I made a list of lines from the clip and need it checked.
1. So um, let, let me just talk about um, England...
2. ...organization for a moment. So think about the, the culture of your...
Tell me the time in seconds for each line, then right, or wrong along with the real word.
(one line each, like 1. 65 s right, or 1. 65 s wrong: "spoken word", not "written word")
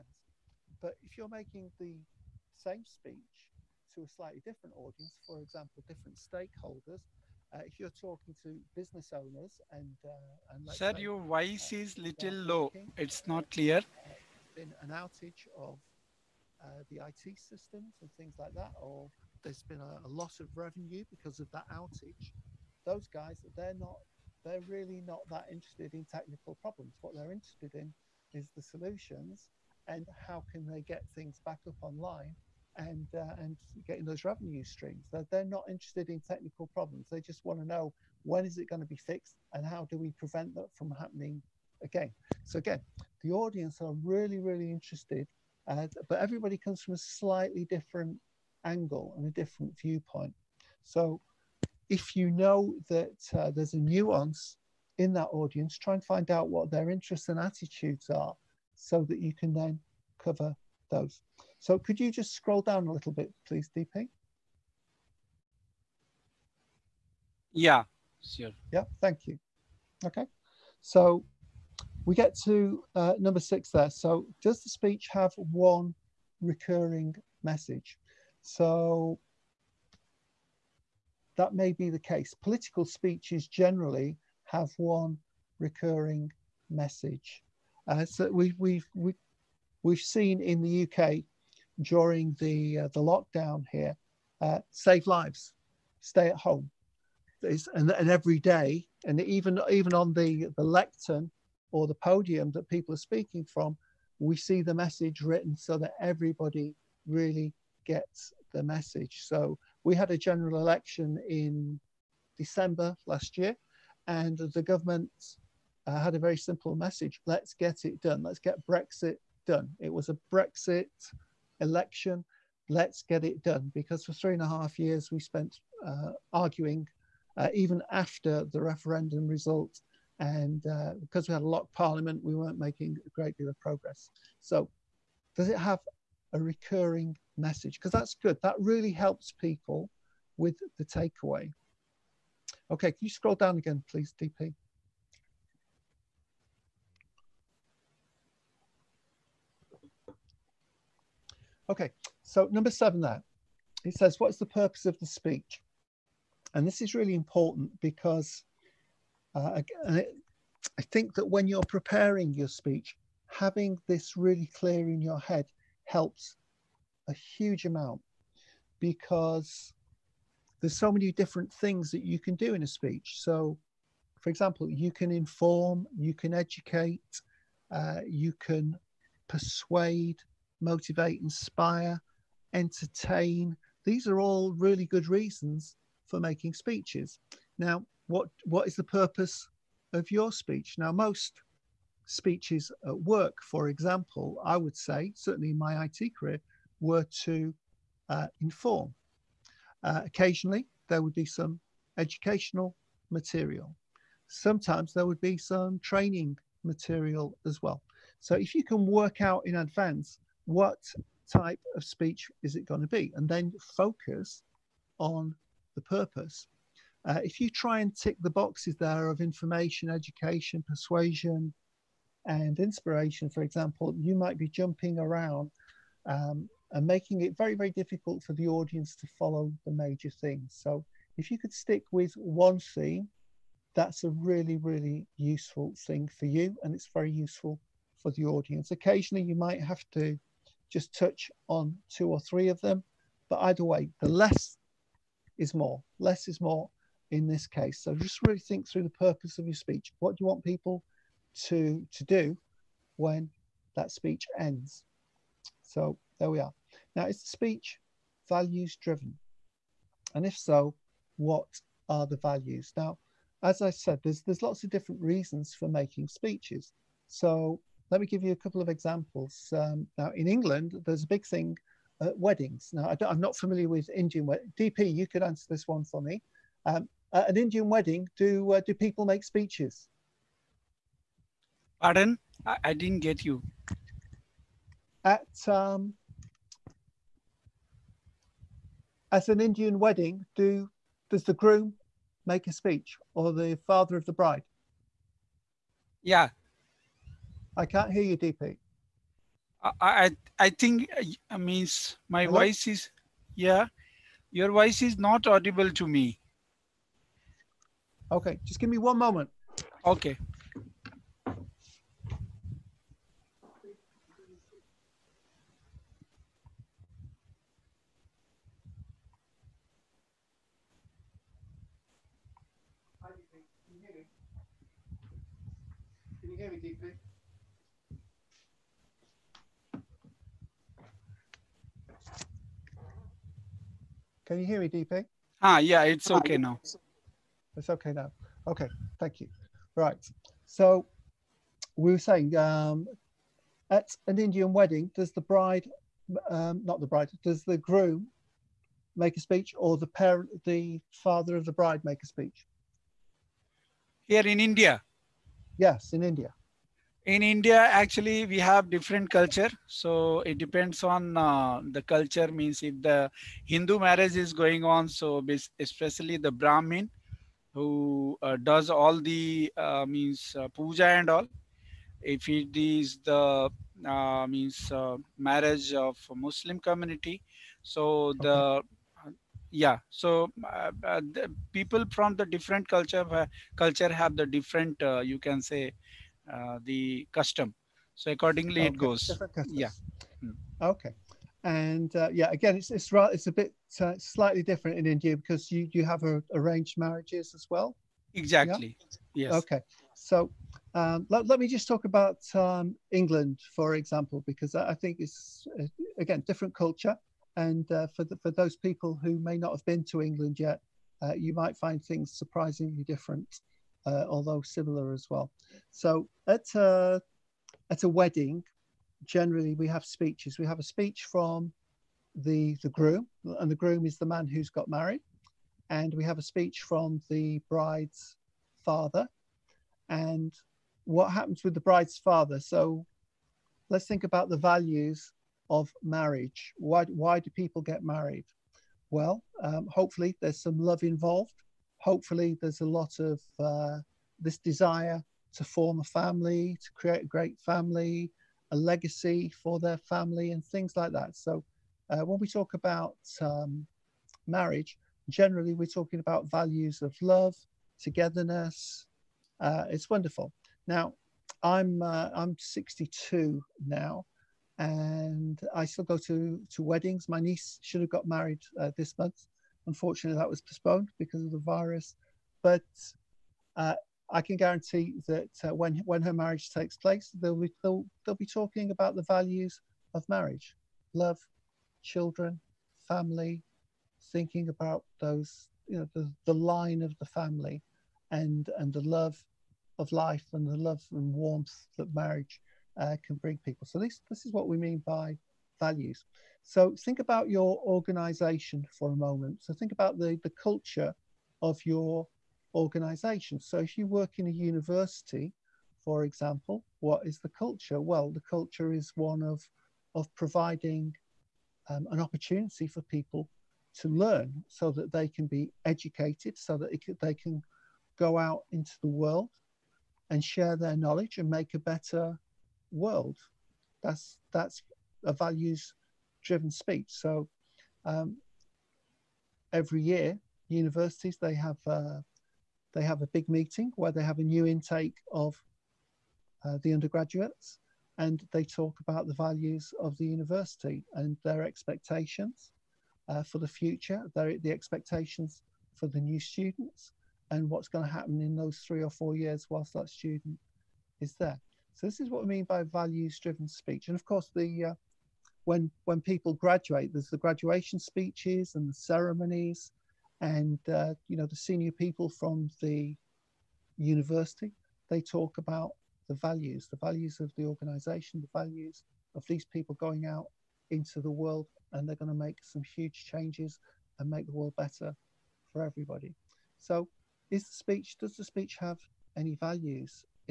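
1. 399 s right
2. 497 s right.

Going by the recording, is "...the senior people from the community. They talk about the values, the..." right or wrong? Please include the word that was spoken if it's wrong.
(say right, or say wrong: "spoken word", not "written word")
wrong: "university", not "community".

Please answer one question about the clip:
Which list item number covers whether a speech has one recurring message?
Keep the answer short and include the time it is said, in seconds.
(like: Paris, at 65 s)
6, at 73 s.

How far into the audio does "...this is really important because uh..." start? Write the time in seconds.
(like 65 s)
156 s.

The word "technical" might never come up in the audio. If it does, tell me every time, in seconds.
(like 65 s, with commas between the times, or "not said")
26 s, 36 s.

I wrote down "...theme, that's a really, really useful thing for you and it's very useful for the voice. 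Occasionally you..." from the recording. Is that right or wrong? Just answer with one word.
wrong.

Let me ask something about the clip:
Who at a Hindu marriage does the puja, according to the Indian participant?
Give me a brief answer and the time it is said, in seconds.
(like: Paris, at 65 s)
the brahmin, at 366 s.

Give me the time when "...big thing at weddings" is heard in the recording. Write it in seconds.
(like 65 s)
271 s.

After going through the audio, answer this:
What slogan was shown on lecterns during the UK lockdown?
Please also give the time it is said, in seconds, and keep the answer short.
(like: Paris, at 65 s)
save lives, stay at home, at 94 s.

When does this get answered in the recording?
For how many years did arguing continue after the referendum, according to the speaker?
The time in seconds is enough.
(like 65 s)
124 s.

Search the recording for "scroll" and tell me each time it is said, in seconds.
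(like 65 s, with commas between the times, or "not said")
62 s, 143 s.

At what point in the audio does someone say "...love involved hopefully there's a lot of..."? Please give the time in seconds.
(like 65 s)
440 s.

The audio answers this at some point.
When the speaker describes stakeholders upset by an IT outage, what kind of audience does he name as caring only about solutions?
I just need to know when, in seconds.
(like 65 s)
8 s.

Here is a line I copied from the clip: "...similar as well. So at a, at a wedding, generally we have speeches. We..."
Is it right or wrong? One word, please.
right.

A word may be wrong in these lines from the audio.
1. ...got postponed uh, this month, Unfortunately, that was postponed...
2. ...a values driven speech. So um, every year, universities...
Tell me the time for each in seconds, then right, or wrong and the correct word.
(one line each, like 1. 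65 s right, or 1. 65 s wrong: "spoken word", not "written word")
1. 467 s wrong: "married", not "postponed"
2. 525 s right.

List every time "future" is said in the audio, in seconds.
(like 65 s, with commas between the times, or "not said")
543 s.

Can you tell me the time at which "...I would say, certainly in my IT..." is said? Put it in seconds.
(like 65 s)
194 s.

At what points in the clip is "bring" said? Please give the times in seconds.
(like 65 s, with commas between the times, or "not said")
493 s.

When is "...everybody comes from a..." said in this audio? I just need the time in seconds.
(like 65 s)
46 s.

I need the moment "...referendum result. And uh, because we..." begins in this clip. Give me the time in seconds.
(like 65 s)
128 s.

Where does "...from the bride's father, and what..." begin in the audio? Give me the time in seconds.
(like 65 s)
426 s.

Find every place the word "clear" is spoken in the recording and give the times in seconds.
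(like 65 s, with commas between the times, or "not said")
13 s, 164 s.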